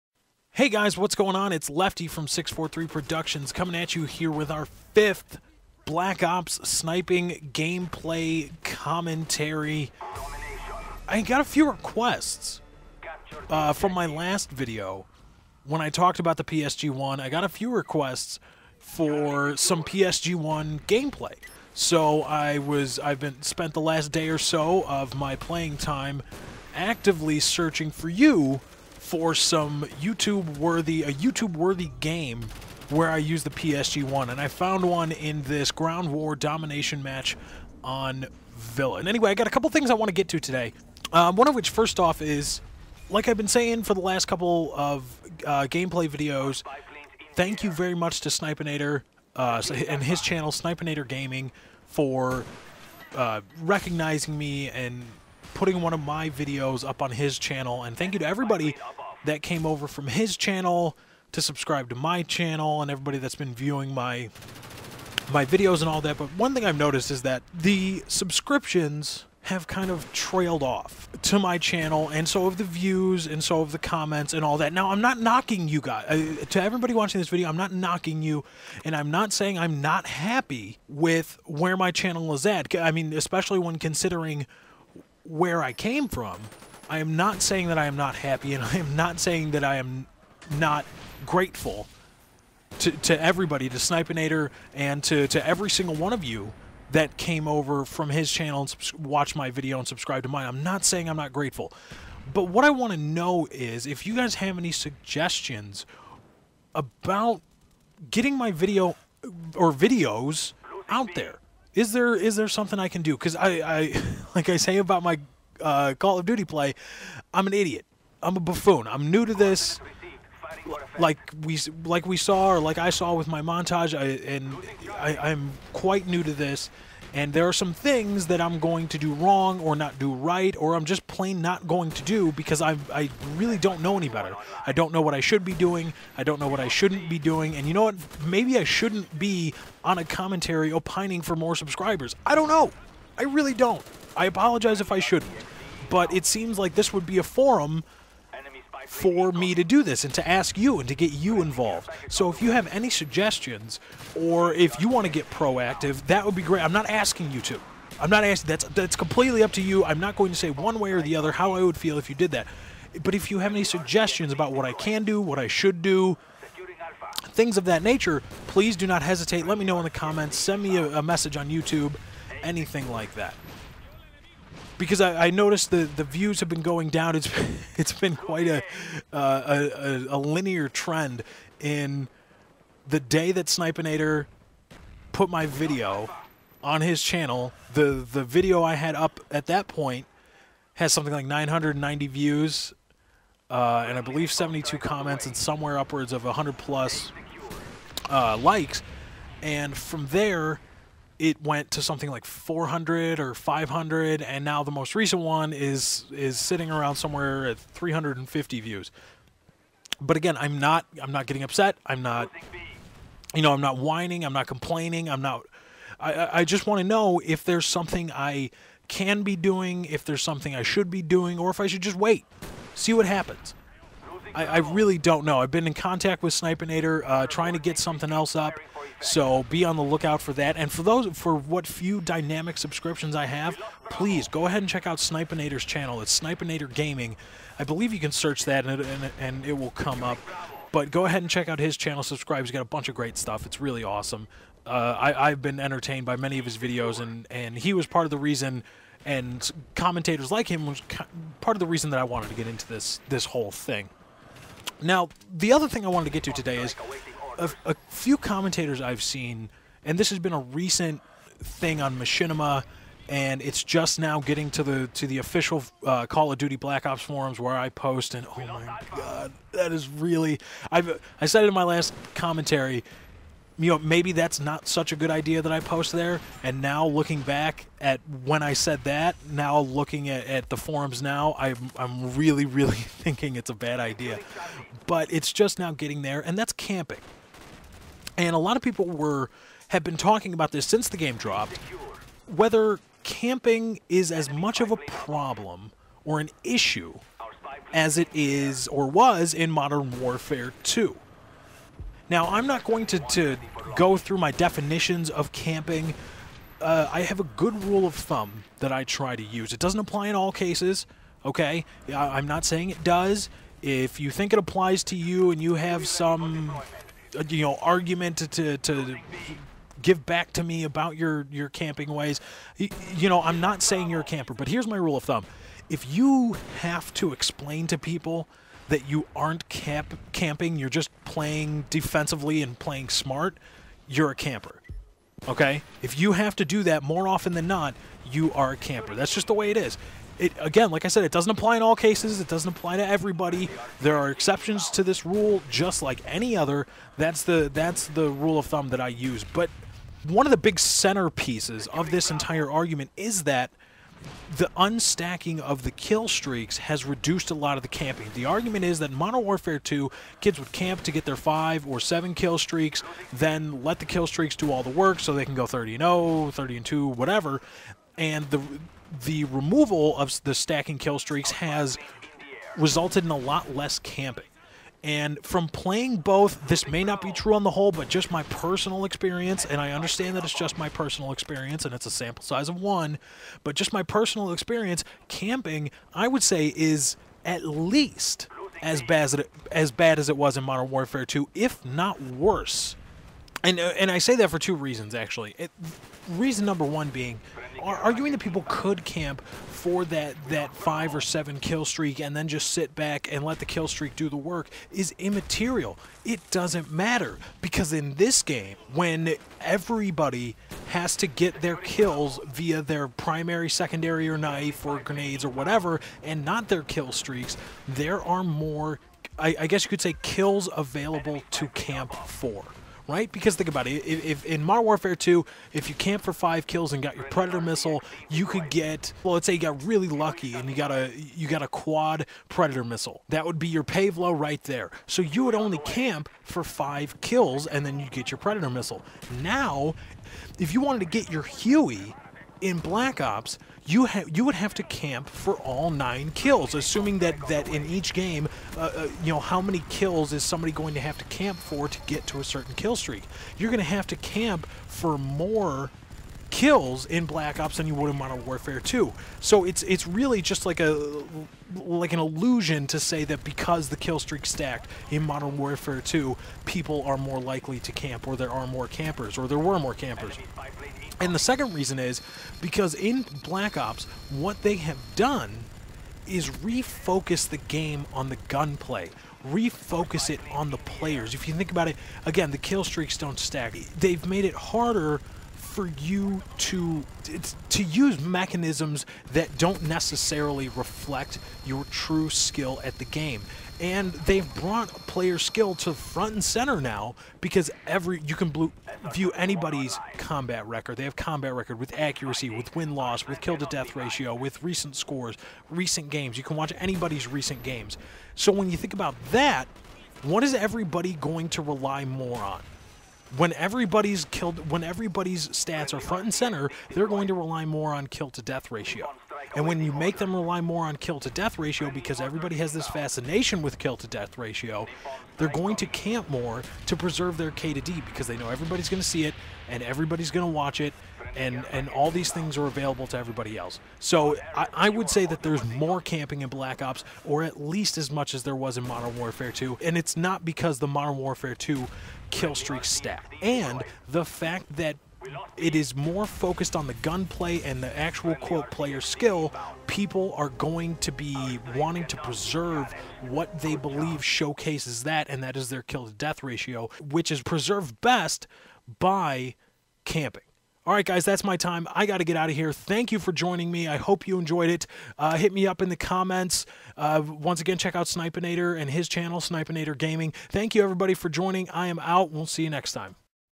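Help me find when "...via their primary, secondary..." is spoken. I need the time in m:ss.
6:52.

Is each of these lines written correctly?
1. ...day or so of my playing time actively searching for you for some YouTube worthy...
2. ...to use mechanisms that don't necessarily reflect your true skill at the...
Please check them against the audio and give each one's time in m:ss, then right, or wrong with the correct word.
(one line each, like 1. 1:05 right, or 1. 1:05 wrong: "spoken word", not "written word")
1. 0:24 right
2. 8:07 right.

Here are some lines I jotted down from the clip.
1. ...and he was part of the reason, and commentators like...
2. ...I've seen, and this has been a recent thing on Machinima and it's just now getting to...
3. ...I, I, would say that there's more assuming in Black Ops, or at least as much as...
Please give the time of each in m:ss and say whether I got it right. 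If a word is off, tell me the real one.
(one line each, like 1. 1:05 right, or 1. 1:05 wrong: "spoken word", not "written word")
1. 4:07 right
2. 4:18 right
3. 8:54 wrong: "camping", not "assuming".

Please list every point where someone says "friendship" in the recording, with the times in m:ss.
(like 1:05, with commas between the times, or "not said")
not said.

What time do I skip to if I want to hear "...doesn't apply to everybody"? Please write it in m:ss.
5:42.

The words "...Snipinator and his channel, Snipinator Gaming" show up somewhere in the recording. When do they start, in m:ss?
9:27.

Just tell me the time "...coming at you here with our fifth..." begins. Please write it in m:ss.
0:03.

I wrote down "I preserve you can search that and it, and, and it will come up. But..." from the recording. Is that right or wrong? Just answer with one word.
wrong.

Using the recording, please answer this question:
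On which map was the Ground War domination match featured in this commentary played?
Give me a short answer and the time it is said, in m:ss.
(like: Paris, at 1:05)
Villa, at 0:38.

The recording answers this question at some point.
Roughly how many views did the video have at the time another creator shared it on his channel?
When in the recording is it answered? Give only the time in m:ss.
3:11.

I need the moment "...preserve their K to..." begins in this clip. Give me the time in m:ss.
8:46.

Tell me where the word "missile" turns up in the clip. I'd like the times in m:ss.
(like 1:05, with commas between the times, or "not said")
7:07, 7:12, 7:18.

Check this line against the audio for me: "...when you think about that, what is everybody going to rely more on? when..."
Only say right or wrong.
right.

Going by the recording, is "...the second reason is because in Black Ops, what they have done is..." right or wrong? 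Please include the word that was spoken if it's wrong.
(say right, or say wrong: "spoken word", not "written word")
right.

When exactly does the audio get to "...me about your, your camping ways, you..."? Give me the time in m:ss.
5:20.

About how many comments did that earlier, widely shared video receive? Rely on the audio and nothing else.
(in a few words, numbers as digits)
72.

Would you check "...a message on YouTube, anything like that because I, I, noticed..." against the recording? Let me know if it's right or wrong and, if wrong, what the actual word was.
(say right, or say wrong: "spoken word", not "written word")
right.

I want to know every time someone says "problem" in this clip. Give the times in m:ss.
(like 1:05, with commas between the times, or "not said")
4:54.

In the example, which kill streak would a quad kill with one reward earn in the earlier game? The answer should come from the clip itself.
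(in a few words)
Pave Low.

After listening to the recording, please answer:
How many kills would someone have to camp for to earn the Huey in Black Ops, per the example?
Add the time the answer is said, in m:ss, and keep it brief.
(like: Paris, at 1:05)
9, at 7:25.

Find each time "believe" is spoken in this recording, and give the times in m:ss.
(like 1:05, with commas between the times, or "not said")
3:14, 3:57, 9:13.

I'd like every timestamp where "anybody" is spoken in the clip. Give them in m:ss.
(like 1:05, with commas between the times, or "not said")
8:19, 8:26.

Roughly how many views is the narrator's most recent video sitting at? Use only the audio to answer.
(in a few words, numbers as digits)
350.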